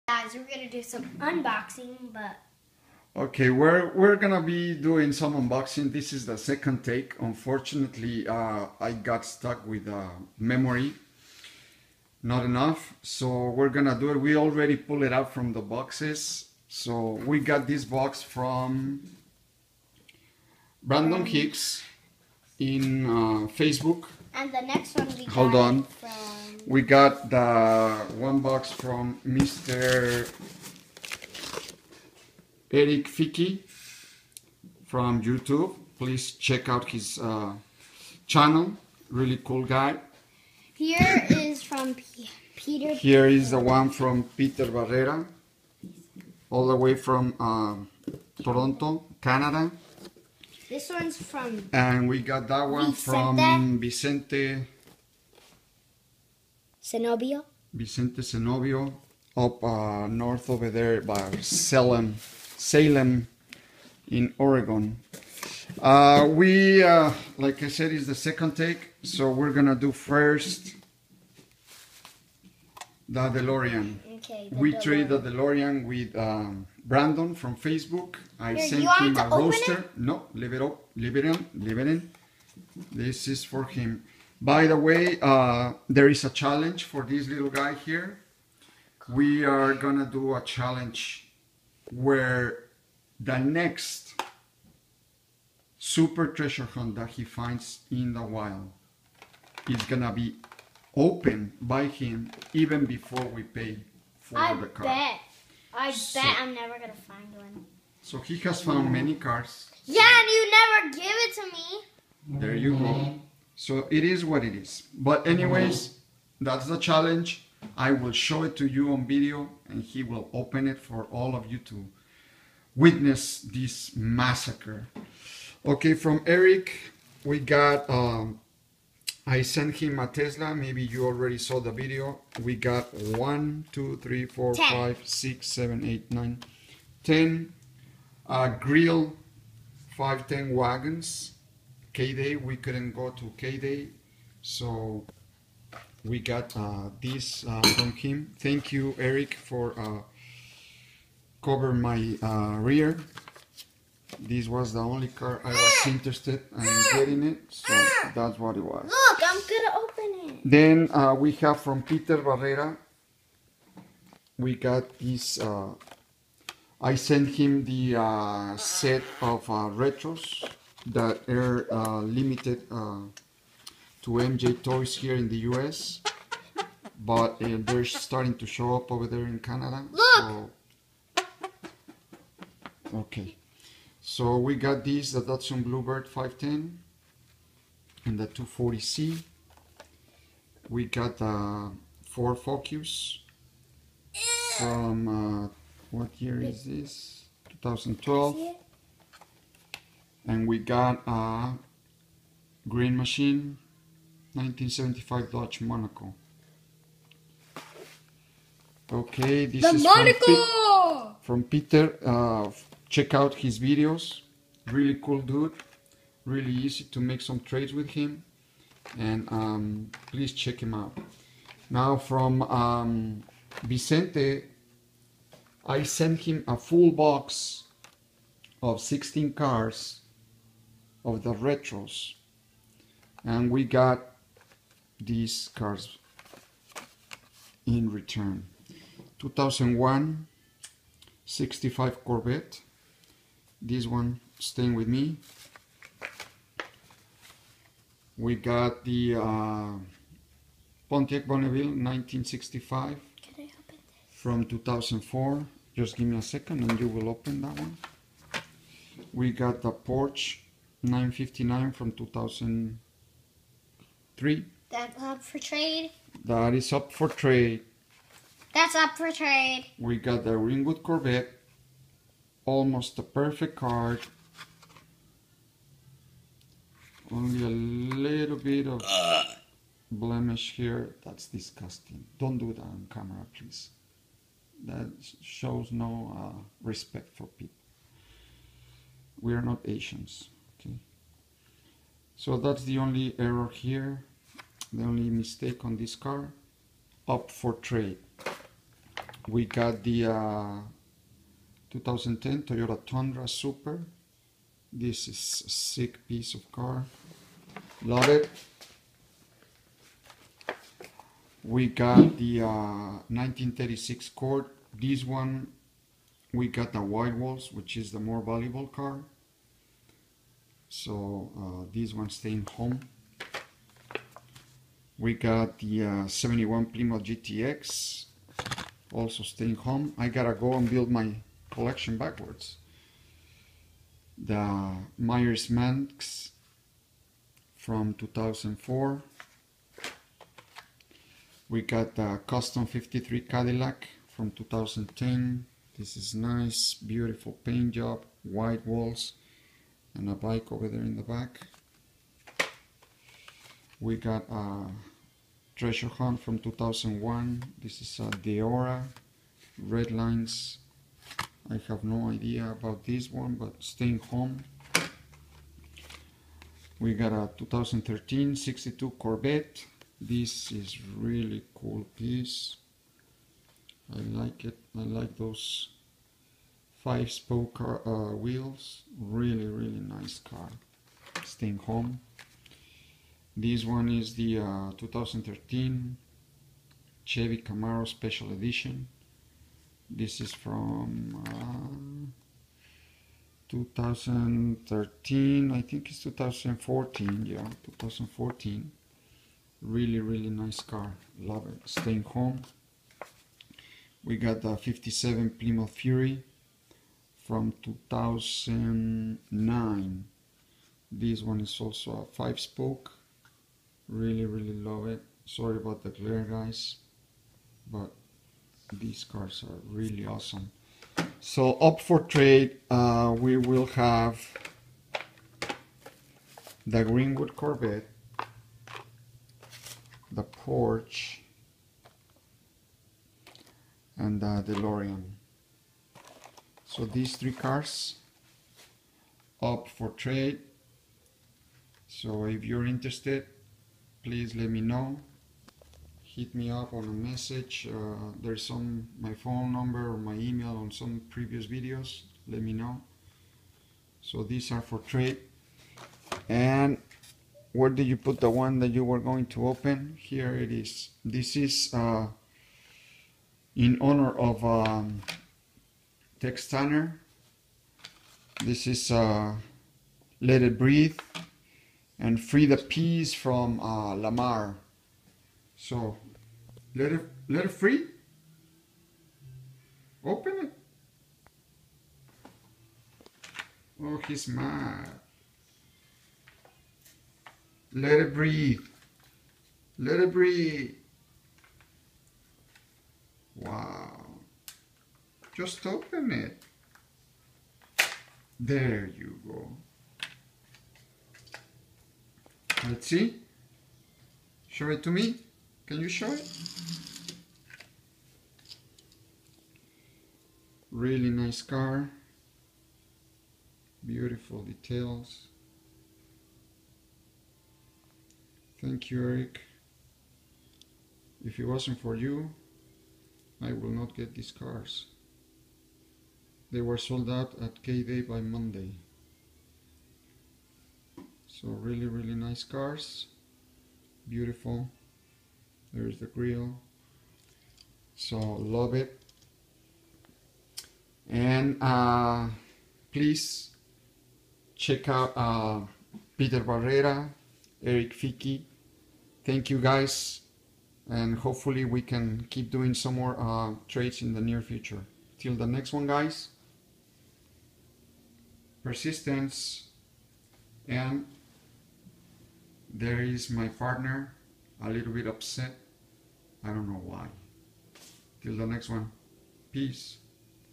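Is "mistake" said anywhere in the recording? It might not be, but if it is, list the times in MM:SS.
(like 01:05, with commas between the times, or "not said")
04:55.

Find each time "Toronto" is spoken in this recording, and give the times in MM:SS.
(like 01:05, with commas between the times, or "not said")
00:48.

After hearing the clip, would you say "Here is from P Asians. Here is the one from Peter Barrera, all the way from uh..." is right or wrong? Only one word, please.
wrong.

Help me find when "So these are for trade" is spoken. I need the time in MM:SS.
07:34.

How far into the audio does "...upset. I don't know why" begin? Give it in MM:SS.
09:25.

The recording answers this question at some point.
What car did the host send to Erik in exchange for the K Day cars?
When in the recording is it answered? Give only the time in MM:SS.
02:10.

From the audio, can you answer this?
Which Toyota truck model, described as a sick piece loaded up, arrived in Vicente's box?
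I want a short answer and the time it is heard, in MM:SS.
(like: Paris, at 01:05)
Toyota Tundra, at 05:02.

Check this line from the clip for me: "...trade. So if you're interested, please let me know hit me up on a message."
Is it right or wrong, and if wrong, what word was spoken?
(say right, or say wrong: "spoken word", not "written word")
right.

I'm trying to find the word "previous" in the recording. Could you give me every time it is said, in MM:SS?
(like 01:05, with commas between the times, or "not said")
07:31.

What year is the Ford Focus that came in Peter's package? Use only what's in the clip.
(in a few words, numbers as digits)
2012.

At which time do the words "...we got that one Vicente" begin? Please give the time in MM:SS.
00:52.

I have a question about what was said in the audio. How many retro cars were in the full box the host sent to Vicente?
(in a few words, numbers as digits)
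16.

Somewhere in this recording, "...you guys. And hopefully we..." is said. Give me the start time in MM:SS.
09:09.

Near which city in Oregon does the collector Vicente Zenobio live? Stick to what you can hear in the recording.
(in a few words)
Salem.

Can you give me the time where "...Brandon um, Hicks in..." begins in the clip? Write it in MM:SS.
00:20.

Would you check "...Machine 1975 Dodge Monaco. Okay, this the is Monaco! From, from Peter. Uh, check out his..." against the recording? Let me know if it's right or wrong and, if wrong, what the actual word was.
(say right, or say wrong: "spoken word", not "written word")
right.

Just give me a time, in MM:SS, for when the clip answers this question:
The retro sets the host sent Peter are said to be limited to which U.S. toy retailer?
02:54.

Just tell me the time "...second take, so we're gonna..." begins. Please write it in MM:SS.
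01:08.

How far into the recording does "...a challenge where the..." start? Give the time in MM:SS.
01:30.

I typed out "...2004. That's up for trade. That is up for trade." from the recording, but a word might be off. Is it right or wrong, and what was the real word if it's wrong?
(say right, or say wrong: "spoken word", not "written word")
wrong: "2003", not "2004".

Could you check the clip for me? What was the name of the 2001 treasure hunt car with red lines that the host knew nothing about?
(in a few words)
Deora.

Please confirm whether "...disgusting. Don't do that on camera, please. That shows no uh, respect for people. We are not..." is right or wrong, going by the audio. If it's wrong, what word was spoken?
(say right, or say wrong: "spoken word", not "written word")
right.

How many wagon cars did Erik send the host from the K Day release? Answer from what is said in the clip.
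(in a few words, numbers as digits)
10.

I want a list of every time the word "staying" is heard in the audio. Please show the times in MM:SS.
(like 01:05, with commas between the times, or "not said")
04:04, 05:22, 05:29, 06:03, 06:21, 06:41.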